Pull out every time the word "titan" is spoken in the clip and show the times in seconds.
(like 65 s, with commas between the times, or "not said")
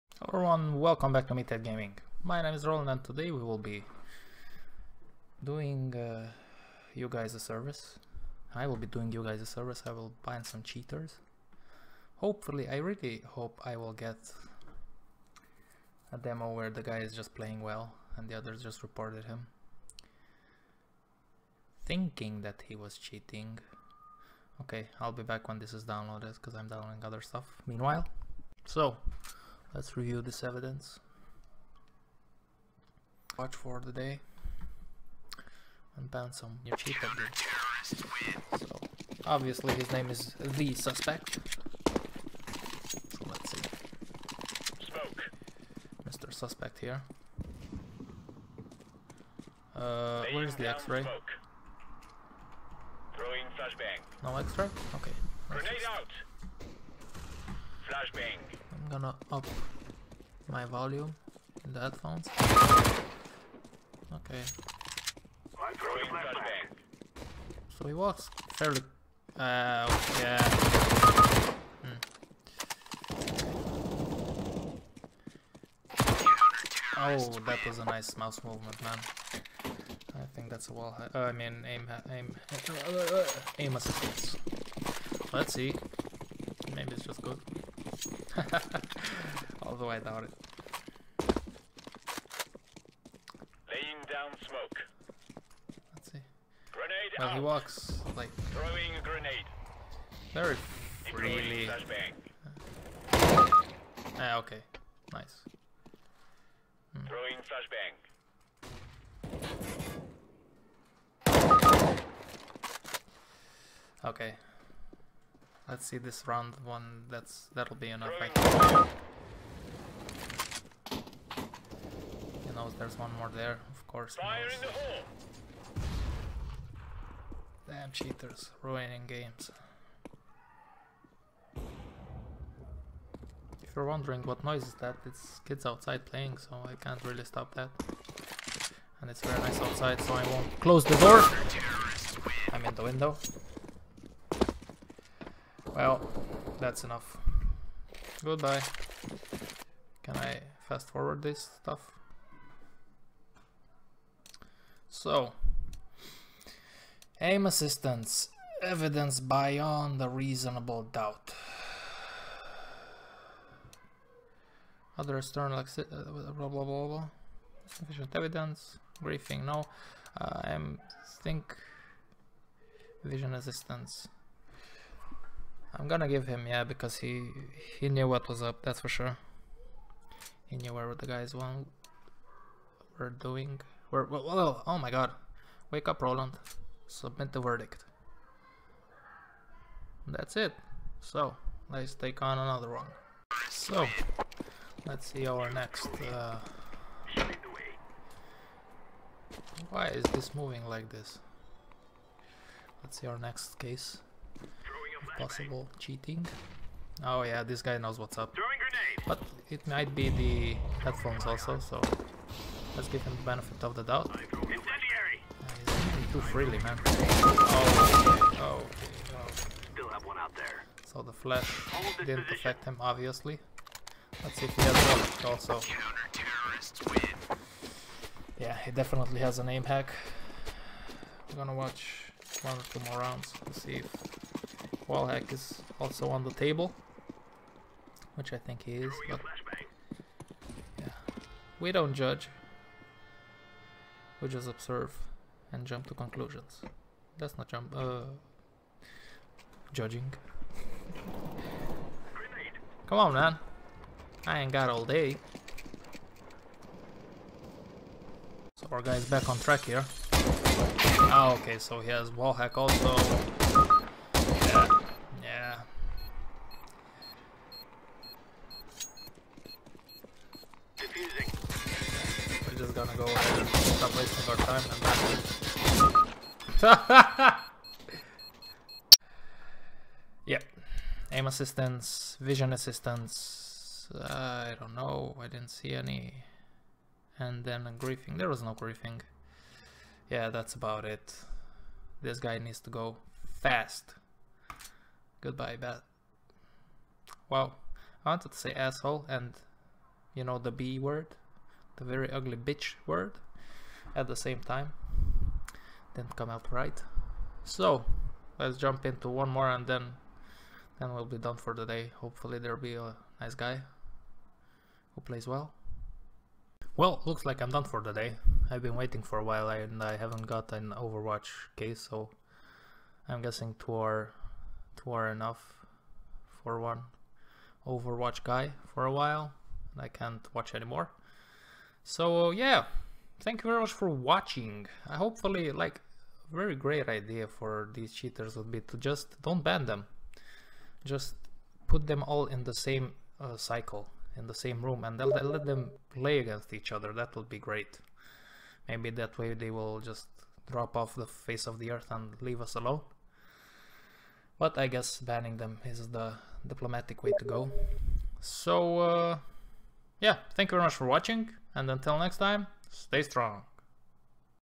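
not said.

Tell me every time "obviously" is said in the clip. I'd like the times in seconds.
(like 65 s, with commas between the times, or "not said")
39 s, 222 s.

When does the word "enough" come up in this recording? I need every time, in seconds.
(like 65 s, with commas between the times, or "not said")
117 s, 146 s, 325 s.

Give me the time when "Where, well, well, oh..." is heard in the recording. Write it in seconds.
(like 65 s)
183 s.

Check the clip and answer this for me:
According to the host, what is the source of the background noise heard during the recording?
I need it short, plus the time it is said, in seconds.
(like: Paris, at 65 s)
kids outside playing, at 135 s.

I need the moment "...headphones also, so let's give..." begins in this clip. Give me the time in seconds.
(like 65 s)
210 s.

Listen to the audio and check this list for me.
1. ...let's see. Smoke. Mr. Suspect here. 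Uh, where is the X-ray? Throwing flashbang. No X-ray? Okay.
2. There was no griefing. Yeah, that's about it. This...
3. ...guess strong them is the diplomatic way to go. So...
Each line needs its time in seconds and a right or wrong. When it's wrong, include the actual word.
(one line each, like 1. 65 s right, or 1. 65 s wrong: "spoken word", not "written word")
1. 43 s right
2. 288 s right
3. 354 s wrong: "banning", not "strong".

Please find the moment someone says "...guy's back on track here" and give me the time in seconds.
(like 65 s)
258 s.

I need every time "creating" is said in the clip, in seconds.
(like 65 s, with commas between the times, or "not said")
not said.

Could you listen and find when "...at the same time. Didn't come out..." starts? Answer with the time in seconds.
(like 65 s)
303 s.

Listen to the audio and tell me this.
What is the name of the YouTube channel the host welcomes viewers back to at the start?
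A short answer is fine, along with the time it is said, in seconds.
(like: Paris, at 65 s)
Meathead Gaming, at 1 s.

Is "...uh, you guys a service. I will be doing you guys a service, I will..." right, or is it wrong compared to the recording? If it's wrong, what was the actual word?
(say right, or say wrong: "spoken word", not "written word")
right.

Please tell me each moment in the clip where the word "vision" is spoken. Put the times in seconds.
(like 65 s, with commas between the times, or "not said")
173 s, 282 s.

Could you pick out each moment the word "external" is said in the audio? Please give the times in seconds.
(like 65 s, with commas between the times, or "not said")
165 s.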